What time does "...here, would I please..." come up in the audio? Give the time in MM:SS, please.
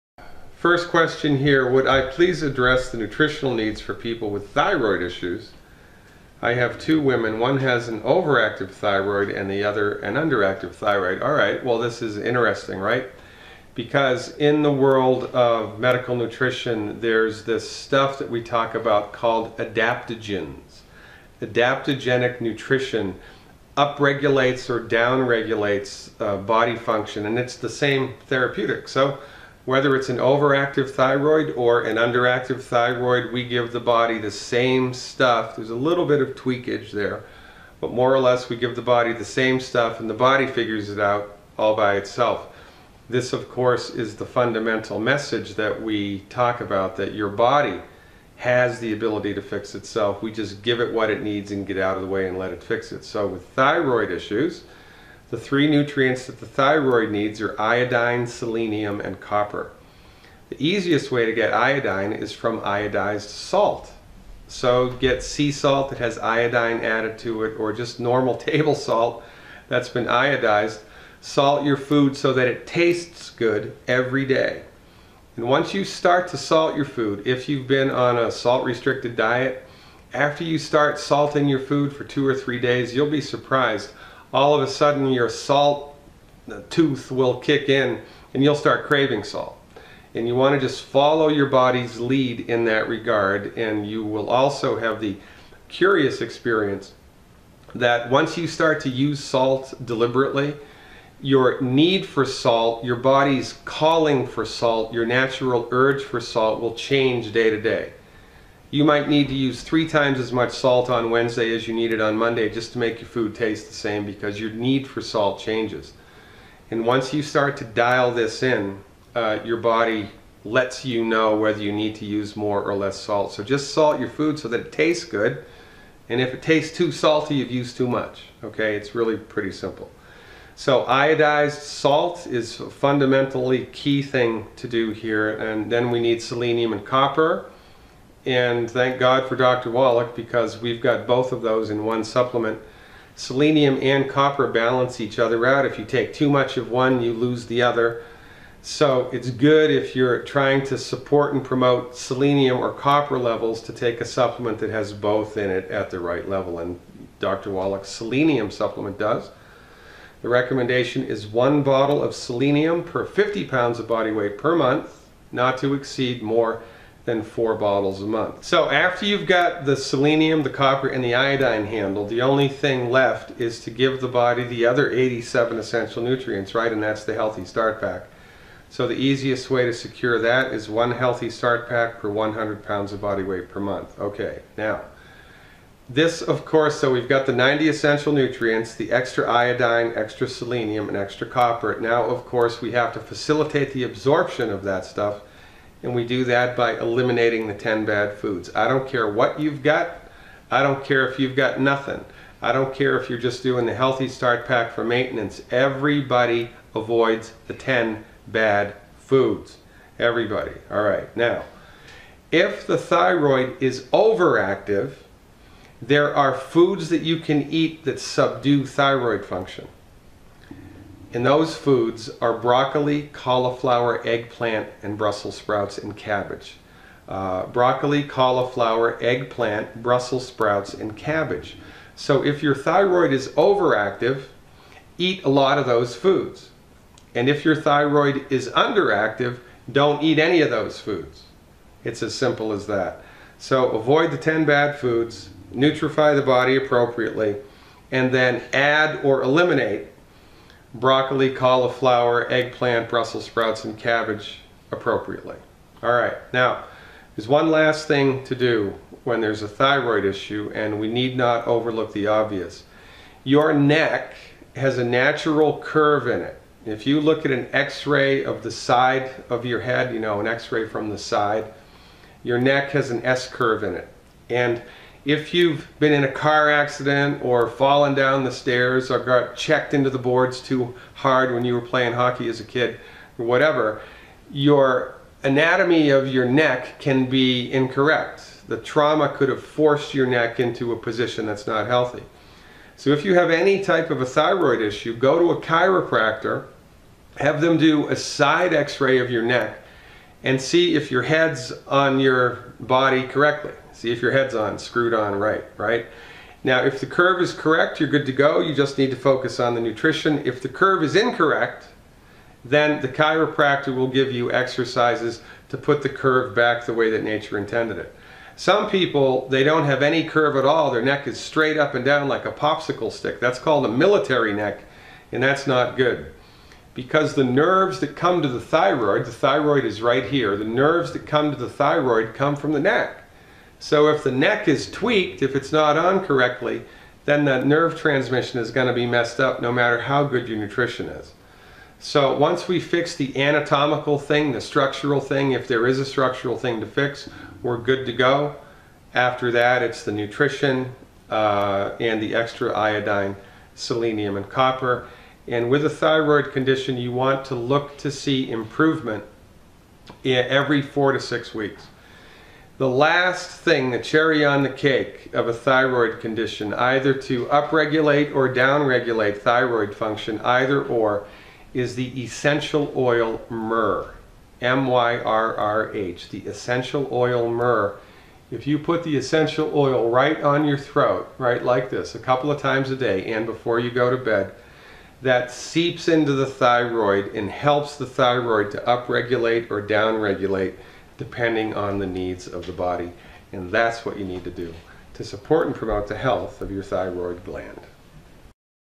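00:01.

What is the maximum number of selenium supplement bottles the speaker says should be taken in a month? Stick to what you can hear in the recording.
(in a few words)
4 bottles.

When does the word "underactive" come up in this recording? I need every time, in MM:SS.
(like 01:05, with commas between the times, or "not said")
00:10, 00:31, 03:58.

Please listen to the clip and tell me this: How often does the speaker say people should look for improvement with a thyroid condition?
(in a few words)
every 4 to 6 weeks.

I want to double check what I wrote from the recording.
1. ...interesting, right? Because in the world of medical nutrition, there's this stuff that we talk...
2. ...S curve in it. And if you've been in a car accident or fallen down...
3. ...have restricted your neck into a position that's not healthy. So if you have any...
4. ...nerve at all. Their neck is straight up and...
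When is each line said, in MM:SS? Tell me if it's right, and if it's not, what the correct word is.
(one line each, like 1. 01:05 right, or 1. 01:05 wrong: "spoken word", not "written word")
1. 00:12 right
2. 04:33 right
3. 04:49 wrong: "forced", not "restricted"
4. 05:20 wrong: "curve", not "nerve".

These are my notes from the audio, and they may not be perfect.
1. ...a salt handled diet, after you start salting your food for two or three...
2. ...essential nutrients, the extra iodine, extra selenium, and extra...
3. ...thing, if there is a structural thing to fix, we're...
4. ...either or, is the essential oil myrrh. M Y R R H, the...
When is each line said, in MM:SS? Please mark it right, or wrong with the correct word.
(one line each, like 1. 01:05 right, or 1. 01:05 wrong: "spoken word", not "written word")
1. 01:18 wrong: "restricted", not "handled"
2. 03:07 right
3. 05:44 right
4. 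06:10 right.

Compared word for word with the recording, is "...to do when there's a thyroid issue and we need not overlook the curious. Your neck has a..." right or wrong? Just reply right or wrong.
wrong.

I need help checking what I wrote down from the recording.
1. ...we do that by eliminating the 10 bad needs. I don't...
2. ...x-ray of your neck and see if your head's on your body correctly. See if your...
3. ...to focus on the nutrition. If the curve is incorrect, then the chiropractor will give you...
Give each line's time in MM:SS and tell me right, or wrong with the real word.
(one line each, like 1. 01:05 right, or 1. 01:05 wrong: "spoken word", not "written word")
1. 03:15 wrong: "foods", not "needs"
2. 04:58 right
3. 05:08 right.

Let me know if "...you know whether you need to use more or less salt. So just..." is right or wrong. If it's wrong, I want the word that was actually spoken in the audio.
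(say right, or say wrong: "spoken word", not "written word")
right.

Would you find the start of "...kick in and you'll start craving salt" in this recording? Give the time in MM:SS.
01:27.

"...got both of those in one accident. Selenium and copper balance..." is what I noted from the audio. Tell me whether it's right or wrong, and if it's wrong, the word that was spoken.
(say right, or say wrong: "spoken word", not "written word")
wrong: "supplement", not "accident".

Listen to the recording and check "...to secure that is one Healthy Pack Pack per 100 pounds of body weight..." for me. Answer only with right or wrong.
wrong.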